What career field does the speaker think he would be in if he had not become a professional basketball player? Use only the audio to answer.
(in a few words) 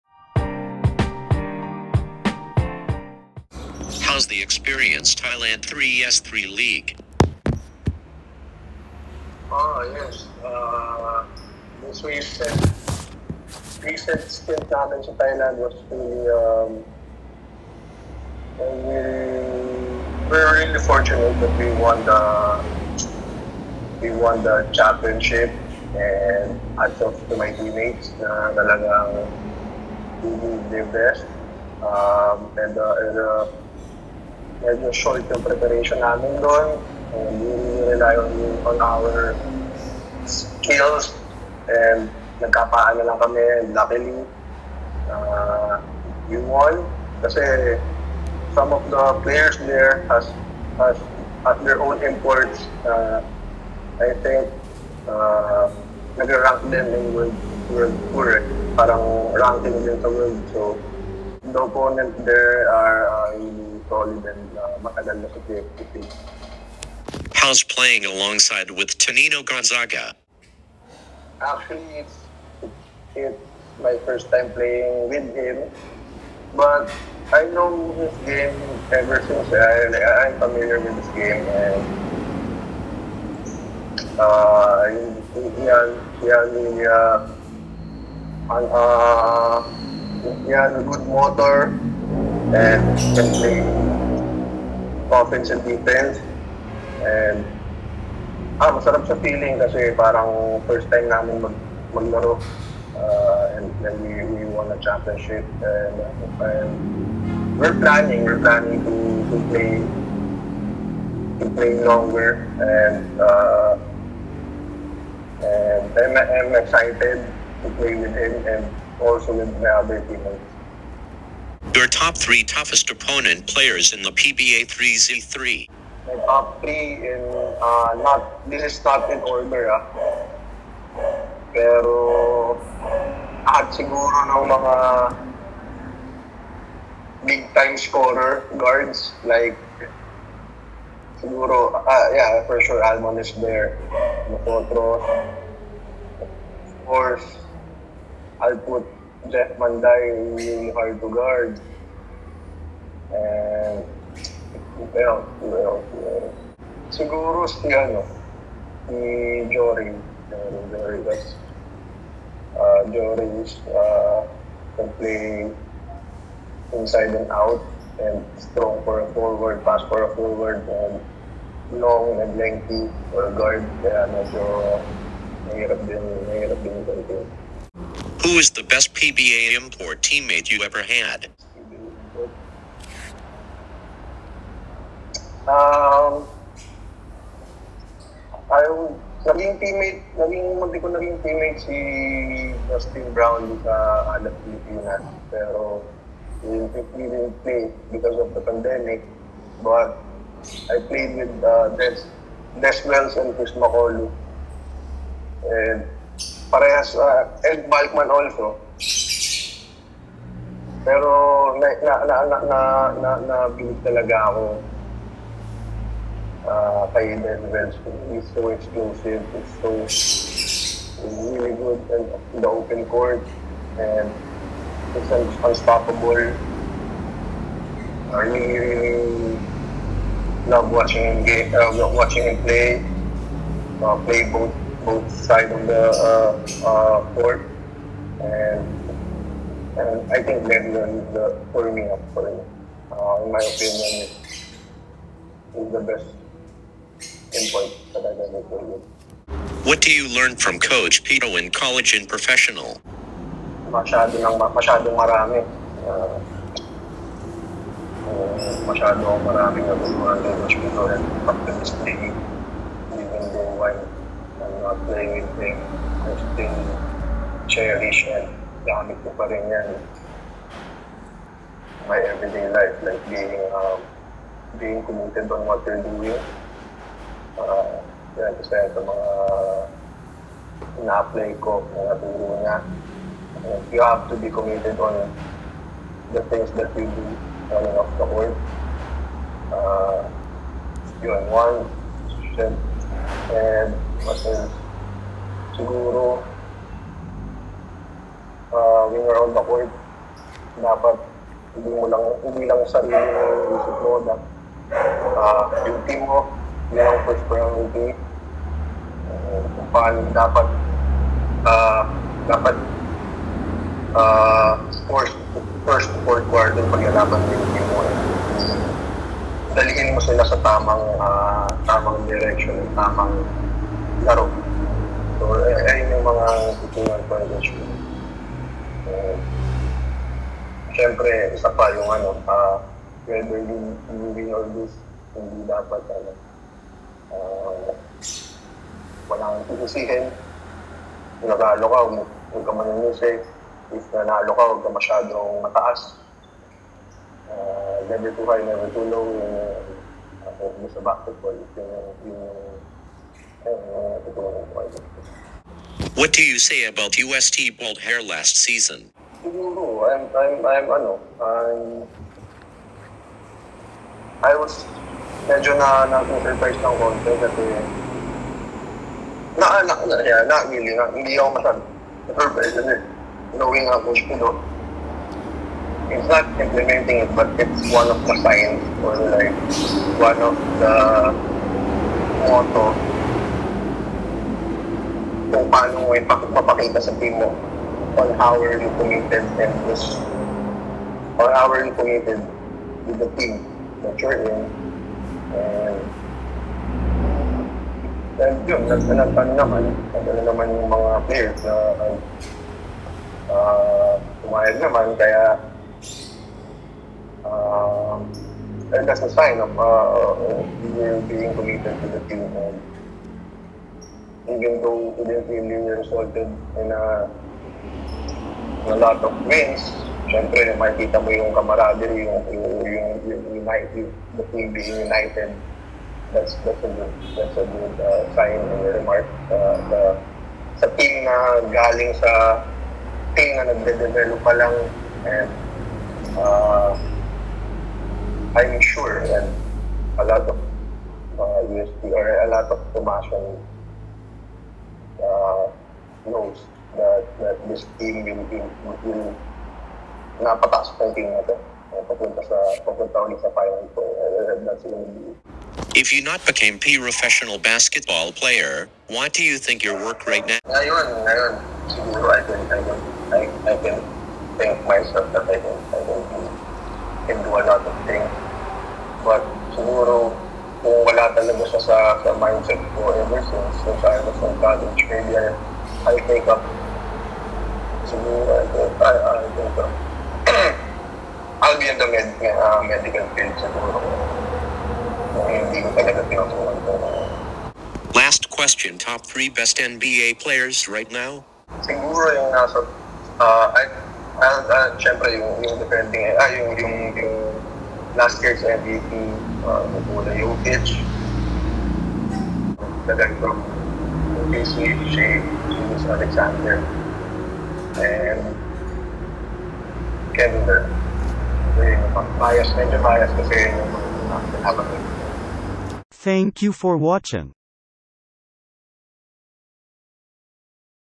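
medical field.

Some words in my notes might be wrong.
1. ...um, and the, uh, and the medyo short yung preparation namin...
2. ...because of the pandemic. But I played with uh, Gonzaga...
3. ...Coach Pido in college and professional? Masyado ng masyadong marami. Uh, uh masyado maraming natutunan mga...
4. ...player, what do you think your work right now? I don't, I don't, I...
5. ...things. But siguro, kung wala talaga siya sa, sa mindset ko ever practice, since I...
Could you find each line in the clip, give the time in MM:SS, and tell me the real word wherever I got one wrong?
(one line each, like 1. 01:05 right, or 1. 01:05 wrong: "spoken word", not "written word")
1. 00:31 right
2. 03:17 wrong: "Des", not "Gonzaga"
3. 04:10 right
4. 07:38 right
5. 07:47 wrong: "since", not "practice".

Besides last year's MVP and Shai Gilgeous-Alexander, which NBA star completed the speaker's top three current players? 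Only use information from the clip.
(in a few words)
Kevin Durant.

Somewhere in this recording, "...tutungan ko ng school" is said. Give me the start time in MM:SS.
05:26.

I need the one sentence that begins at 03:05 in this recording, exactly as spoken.
Um, ayaw, naging teammate, naging, hindi ko naging teammate si Justin Brown sa Anak Pilipinas.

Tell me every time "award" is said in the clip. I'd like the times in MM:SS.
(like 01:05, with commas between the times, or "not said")
not said.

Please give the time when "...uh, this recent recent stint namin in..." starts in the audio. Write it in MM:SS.
00:10.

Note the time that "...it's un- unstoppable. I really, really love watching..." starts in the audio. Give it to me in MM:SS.
03:44.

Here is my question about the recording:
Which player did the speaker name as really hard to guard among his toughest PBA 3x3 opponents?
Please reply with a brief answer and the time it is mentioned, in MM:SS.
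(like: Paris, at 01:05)
Jeff Manday, at 02:29.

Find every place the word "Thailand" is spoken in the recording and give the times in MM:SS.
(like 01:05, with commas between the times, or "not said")
00:05, 00:15.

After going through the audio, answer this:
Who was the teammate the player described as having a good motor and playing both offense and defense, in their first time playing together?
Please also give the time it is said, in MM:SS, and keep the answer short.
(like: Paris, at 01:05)
Tonino Gonzaga, at 01:08.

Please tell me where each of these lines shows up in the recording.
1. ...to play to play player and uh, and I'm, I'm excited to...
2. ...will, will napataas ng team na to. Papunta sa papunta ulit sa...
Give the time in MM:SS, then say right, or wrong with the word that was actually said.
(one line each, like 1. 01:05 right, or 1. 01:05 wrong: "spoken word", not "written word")
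1. 01:49 wrong: "longer", not "player"
2. 07:28 right.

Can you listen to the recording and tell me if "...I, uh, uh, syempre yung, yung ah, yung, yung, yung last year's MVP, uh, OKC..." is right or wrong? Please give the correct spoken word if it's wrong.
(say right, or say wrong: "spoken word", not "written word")
wrong: "Nikola", not "OKC".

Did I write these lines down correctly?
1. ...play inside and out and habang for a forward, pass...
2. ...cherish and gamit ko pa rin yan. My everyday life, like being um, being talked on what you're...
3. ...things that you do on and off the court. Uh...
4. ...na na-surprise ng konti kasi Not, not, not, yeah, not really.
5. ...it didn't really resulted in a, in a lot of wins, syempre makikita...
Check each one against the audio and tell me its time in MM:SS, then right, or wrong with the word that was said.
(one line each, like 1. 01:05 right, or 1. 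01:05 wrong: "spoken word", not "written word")
1. 02:44 wrong: "strong", not "habang"
2. 04:27 wrong: "committed", not "talked"
3. 04:46 right
4. 06:05 right
5. 06:54 right.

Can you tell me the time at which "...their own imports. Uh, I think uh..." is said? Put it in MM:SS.
00:51.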